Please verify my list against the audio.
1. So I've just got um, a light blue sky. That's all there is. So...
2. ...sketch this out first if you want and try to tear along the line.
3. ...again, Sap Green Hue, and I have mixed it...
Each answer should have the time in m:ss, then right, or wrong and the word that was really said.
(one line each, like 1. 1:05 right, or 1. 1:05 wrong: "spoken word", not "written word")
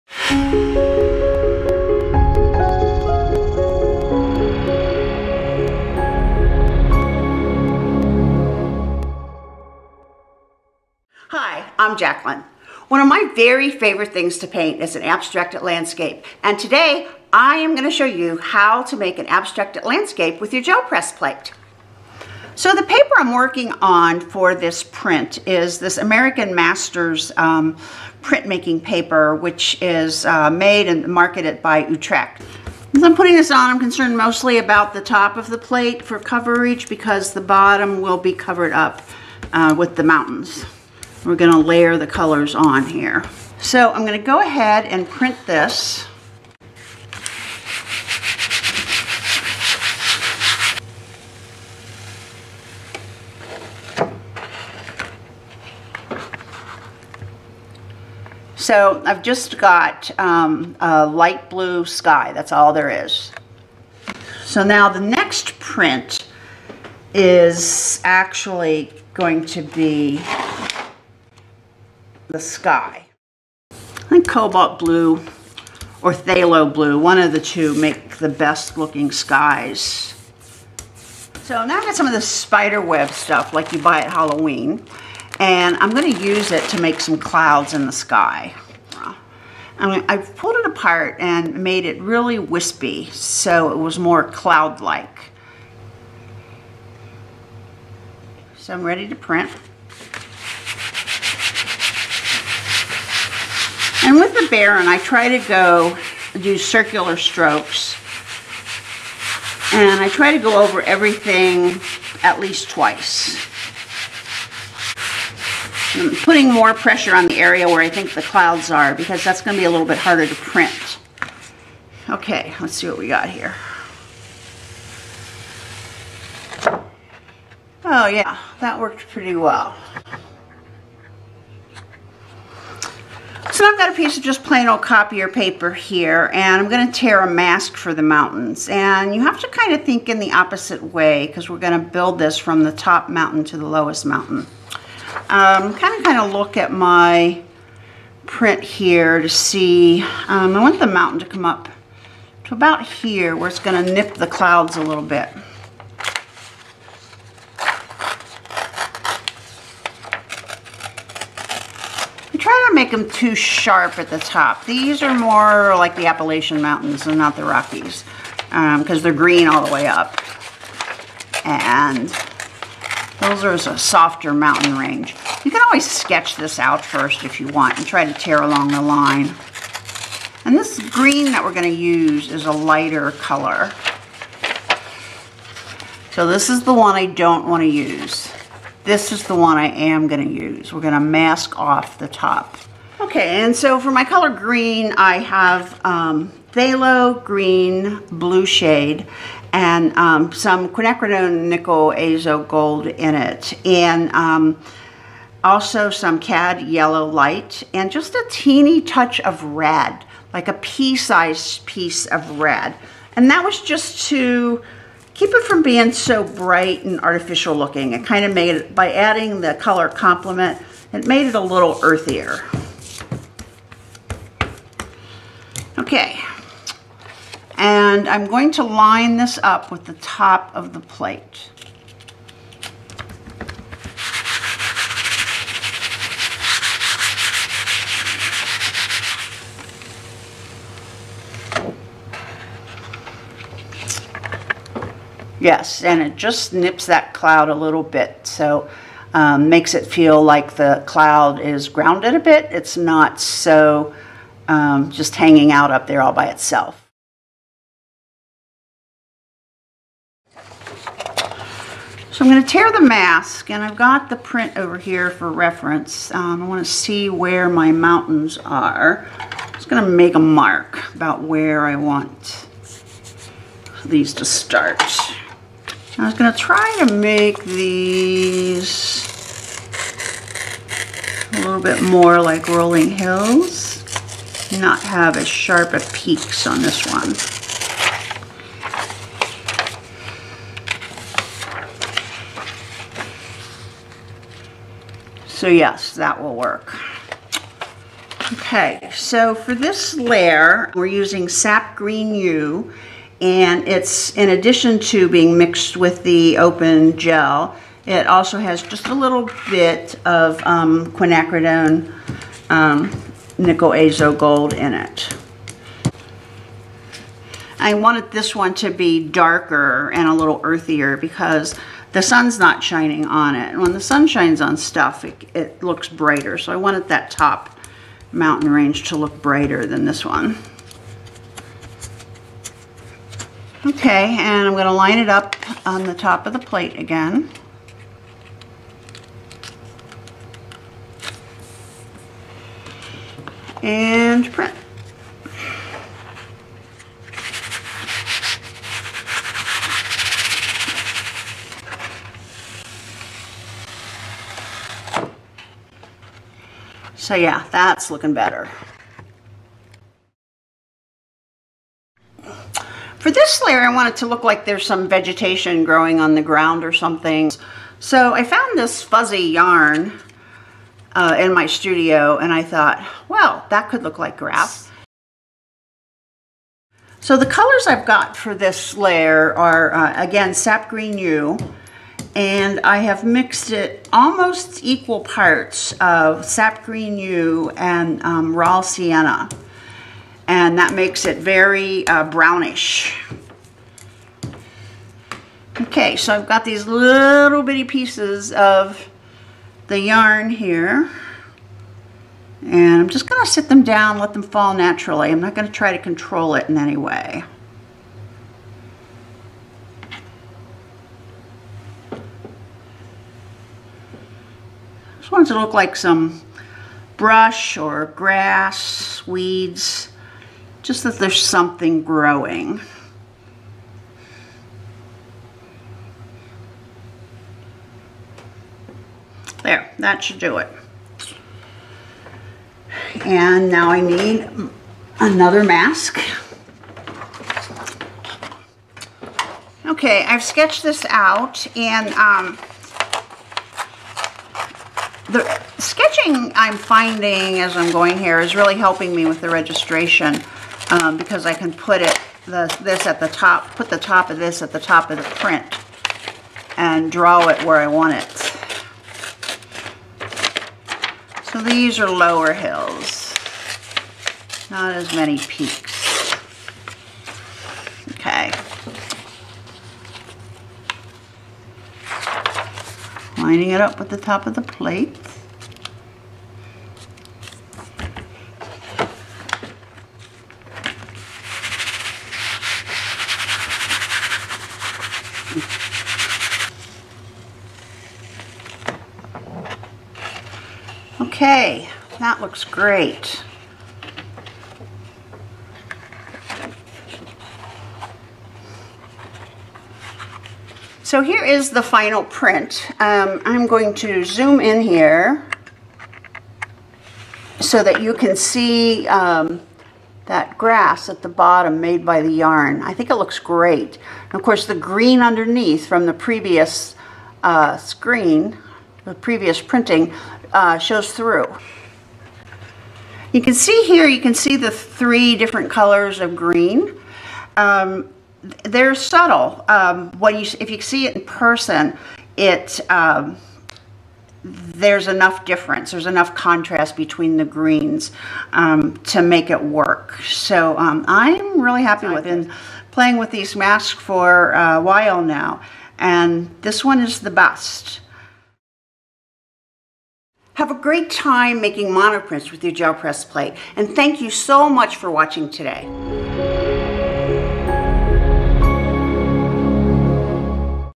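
1. 0:58 right
2. 2:55 right
3. 6:20 right.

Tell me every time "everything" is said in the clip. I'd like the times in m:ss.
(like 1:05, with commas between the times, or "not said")
1:50.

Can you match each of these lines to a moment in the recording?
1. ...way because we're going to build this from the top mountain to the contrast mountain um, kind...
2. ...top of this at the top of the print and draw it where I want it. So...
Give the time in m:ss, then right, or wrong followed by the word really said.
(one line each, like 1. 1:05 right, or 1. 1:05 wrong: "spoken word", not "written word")
1. 2:20 wrong: "lowest", not "contrast"
2. 7:33 right.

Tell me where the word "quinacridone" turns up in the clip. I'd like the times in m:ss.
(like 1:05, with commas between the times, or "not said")
3:20, 5:10.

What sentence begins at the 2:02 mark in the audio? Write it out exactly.
Okay, let's see what we got here.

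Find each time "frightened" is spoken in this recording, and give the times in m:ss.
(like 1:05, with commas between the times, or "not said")
not said.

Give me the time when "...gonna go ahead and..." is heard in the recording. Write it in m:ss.
0:44.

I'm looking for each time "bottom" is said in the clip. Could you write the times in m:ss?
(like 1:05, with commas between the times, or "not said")
0:37, 8:31.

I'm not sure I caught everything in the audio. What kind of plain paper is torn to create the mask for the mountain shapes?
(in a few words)
copier paper.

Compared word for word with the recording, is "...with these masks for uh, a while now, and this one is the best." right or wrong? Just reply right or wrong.
right.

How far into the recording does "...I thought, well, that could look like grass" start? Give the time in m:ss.
6:12.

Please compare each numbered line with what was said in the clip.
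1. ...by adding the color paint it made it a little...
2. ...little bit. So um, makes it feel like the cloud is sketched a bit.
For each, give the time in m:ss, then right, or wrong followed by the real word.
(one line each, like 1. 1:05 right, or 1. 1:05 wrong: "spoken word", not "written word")
1. 3:38 wrong: "complement", not "paint"
2. 4:07 wrong: "grounded", not "sketched".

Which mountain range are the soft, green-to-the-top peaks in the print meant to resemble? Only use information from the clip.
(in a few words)
Appalachian Mountains.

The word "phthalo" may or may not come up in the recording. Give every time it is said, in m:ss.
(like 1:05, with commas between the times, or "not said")
1:16, 3:16.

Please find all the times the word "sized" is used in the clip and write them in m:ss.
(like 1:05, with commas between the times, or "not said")
3:30.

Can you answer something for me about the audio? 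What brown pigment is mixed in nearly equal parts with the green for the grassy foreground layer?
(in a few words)
raw sienna.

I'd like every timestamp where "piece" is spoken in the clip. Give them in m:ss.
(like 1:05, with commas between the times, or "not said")
2:13, 3:31, 6:37.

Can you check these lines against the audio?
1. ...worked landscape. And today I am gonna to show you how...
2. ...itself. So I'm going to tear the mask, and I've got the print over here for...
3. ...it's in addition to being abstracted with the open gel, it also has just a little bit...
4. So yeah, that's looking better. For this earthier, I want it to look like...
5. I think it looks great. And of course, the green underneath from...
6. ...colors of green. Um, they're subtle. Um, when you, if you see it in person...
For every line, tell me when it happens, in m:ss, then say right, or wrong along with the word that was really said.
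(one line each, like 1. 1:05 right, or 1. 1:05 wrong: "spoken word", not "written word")
1. 0:15 wrong: "abstracted", not "worked"
2. 4:16 right
3. 5:03 wrong: "mixed", not "abstracted"
4. 5:57 wrong: "layer", not "earthier"
5. 8:32 right
6. 8:45 right.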